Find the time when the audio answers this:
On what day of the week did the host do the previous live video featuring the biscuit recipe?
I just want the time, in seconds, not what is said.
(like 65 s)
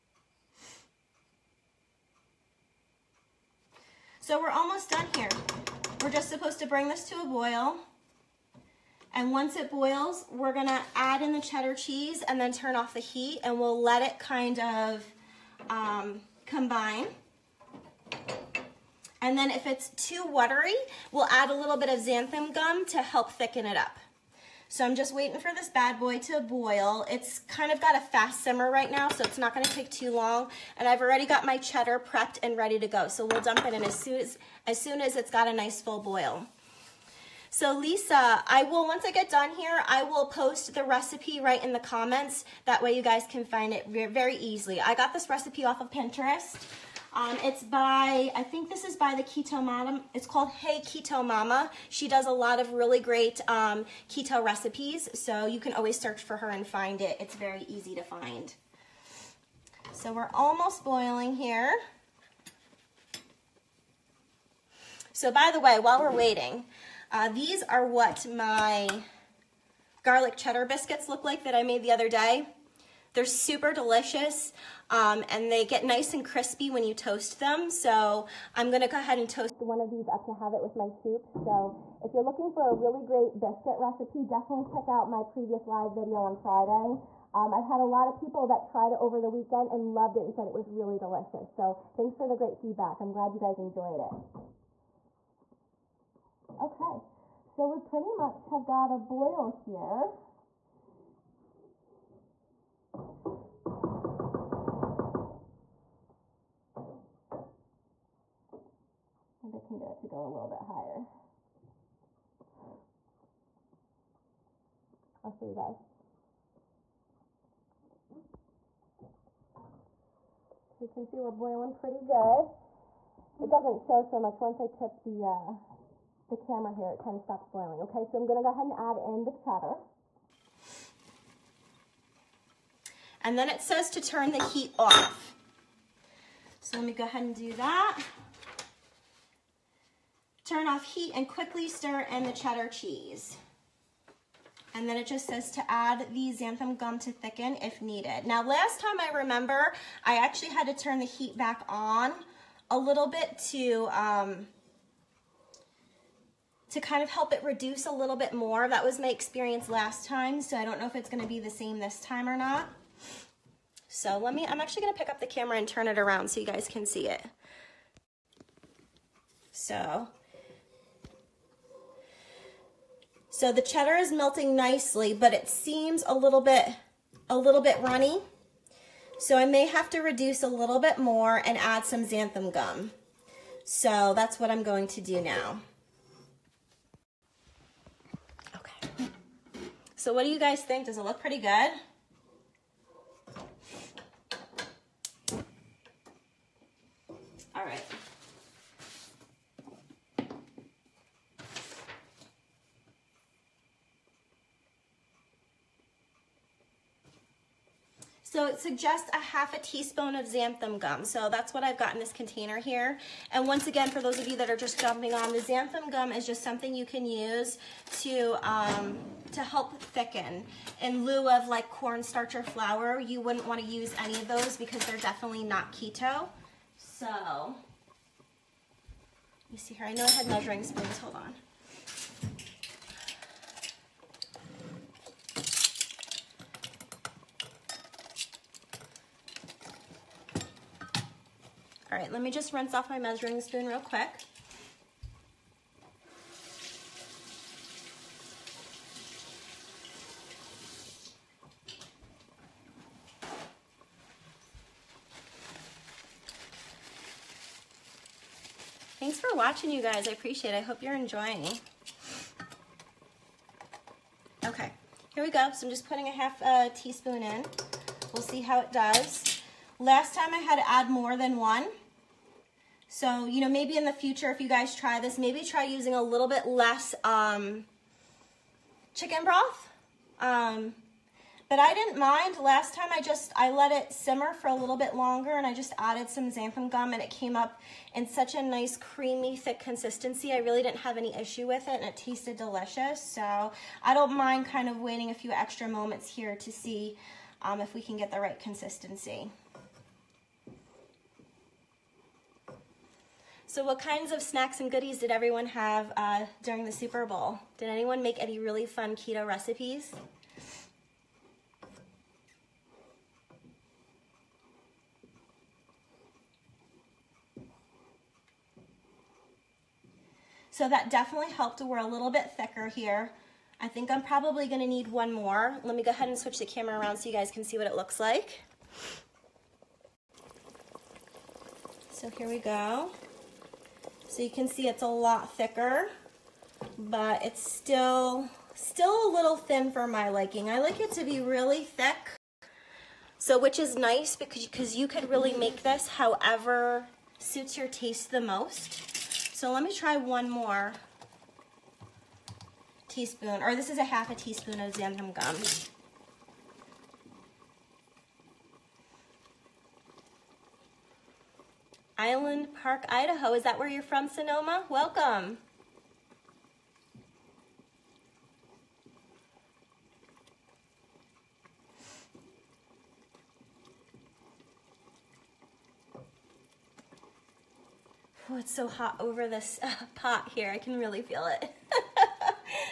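86 s.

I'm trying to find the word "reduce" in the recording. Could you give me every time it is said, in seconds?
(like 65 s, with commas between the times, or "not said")
157 s, 180 s.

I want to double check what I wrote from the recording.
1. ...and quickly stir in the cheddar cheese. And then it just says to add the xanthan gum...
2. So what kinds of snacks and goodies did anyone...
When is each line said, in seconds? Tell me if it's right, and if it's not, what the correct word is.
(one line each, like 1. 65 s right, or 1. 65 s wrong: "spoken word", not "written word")
1. 141 s right
2. 303 s wrong: "everyone", not "anyone".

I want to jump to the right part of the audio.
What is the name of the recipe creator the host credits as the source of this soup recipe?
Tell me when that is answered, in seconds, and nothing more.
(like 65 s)
50 s.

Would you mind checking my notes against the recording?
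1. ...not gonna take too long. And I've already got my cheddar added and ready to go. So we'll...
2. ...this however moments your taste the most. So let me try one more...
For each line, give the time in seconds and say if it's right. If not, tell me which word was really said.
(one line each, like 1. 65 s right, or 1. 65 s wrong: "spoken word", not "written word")
1. 29 s wrong: "prepped", not "added"
2. 345 s wrong: "suits", not "moments".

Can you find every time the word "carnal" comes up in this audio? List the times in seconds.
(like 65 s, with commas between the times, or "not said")
not said.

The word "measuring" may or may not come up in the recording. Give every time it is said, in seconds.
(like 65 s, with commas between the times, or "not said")
230 s, 242 s.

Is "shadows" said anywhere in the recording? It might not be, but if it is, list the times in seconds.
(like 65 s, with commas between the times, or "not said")
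not said.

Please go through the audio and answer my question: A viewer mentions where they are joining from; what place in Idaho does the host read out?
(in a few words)
Island Park.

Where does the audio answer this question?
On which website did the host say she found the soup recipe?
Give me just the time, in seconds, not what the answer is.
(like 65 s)
45 s.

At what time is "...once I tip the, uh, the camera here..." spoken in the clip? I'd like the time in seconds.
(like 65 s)
124 s.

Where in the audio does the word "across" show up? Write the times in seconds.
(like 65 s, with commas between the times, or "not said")
not said.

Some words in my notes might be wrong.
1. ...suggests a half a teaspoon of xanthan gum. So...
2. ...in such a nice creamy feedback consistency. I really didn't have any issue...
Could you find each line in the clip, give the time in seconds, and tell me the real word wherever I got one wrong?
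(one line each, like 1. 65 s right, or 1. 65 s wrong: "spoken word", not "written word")
1. 208 s right
2. 287 s wrong: "thick", not "feedback".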